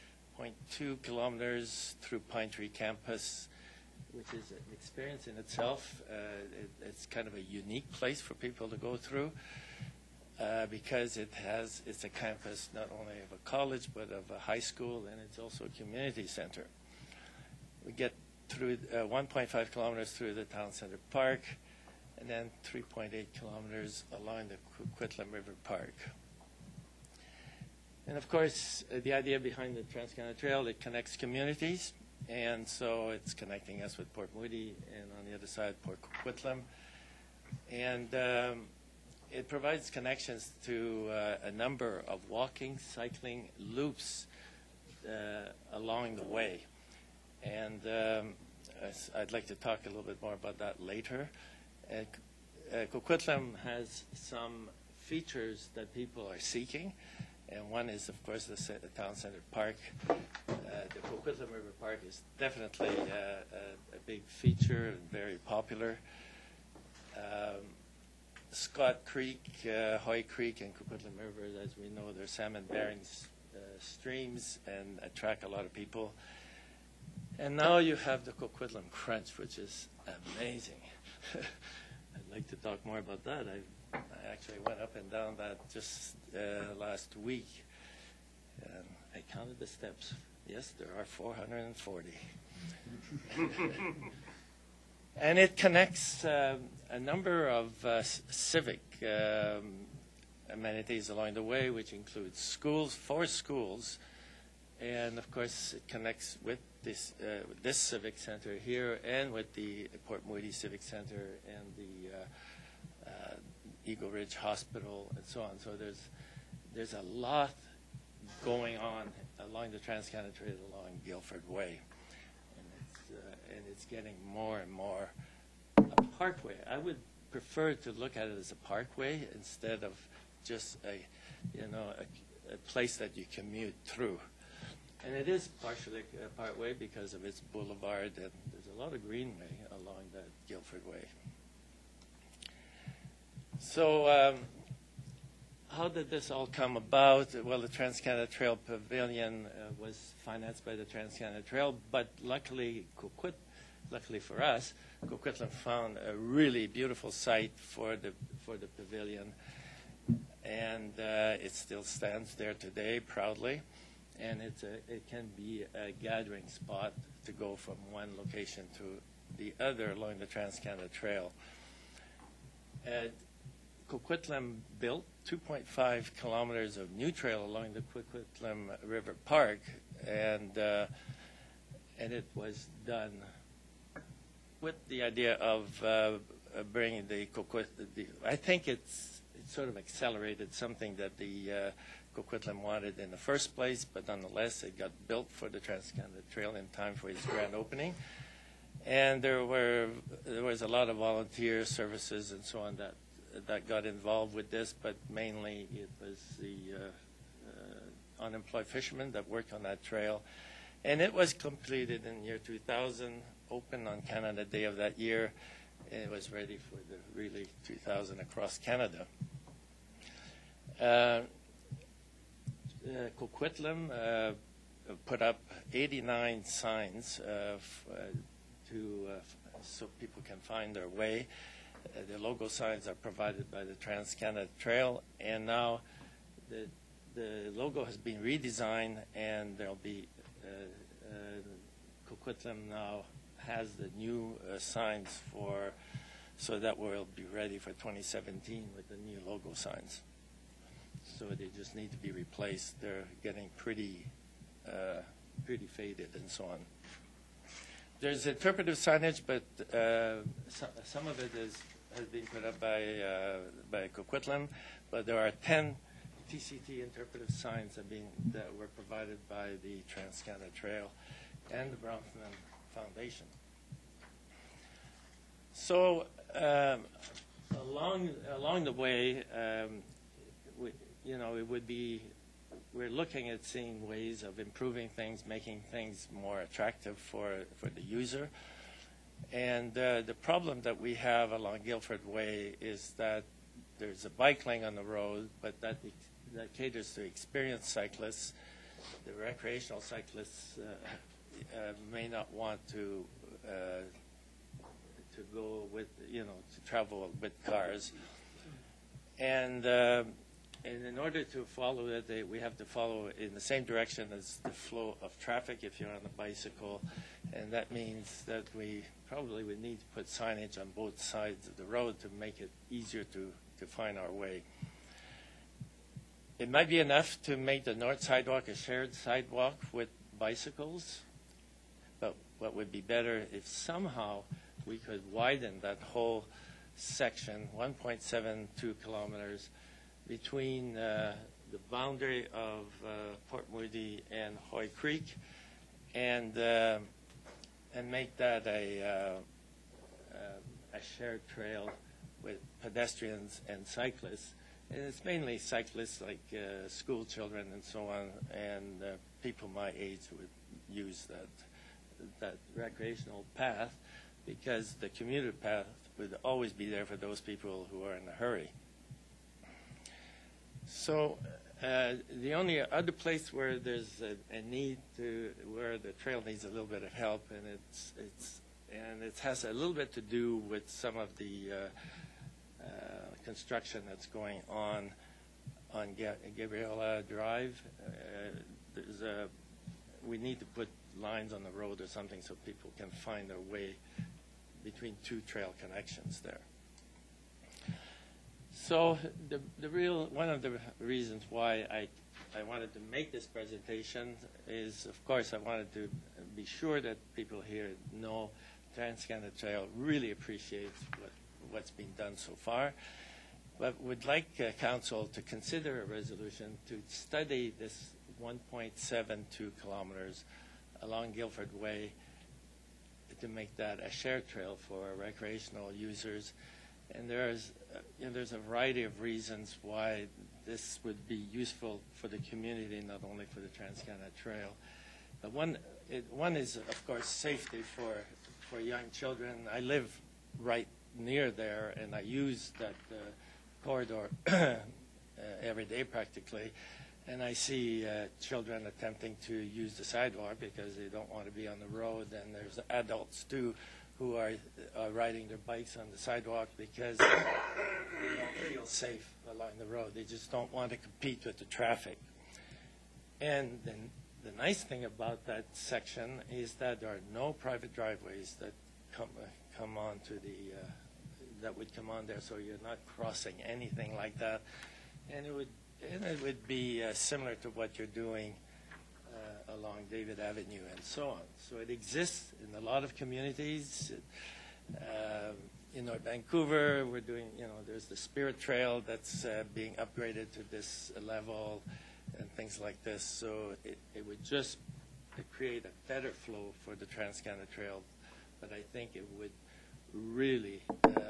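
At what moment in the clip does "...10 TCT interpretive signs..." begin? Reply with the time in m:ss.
4:25.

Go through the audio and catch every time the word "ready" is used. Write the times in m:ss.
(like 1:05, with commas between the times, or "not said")
3:36, 4:07.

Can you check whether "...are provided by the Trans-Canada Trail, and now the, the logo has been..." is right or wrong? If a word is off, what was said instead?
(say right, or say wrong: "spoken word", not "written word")
right.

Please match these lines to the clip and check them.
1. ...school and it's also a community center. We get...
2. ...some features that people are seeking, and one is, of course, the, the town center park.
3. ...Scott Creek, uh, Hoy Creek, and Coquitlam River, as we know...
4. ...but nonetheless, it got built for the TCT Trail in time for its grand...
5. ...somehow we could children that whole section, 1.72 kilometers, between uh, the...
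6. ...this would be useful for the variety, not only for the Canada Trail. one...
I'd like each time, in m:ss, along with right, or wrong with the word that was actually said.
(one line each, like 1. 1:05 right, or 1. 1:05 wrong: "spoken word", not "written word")
1. 0:14 right
2. 0:54 right
3. 1:08 right
4. 3:13 wrong: "Transcanada", not "TCT"
5. 5:33 wrong: "widen", not "children"
6. 7:10 wrong: "community", not "variety".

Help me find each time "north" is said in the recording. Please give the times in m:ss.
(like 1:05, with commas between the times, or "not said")
5:27, 8:05.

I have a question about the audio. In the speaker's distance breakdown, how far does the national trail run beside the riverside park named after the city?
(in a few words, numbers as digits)
3.8 kilometers.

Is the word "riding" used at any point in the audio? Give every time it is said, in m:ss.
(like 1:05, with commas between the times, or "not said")
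7:34.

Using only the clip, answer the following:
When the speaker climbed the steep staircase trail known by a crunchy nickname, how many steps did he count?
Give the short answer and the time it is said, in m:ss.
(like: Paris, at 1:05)
440, at 1:31.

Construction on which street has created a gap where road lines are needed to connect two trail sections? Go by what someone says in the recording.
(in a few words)
Gabriela Drive.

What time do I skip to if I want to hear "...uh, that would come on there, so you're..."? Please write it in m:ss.
7:50.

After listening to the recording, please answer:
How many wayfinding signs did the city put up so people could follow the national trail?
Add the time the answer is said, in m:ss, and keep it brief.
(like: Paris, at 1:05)
89, at 3:45.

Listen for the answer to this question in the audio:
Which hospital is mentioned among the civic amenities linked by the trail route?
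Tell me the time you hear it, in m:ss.
1:53.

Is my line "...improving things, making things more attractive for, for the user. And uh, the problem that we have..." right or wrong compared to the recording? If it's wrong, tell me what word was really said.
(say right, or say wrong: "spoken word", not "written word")
right.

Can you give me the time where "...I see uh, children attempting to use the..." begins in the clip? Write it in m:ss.
7:27.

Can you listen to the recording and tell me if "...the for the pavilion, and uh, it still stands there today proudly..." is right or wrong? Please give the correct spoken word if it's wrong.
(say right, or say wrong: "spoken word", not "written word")
right.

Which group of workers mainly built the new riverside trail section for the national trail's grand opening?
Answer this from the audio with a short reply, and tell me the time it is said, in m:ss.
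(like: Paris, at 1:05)
unemployed fishermen, at 3:28.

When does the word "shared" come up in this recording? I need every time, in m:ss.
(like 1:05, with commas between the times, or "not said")
5:28, 5:50, 7:03.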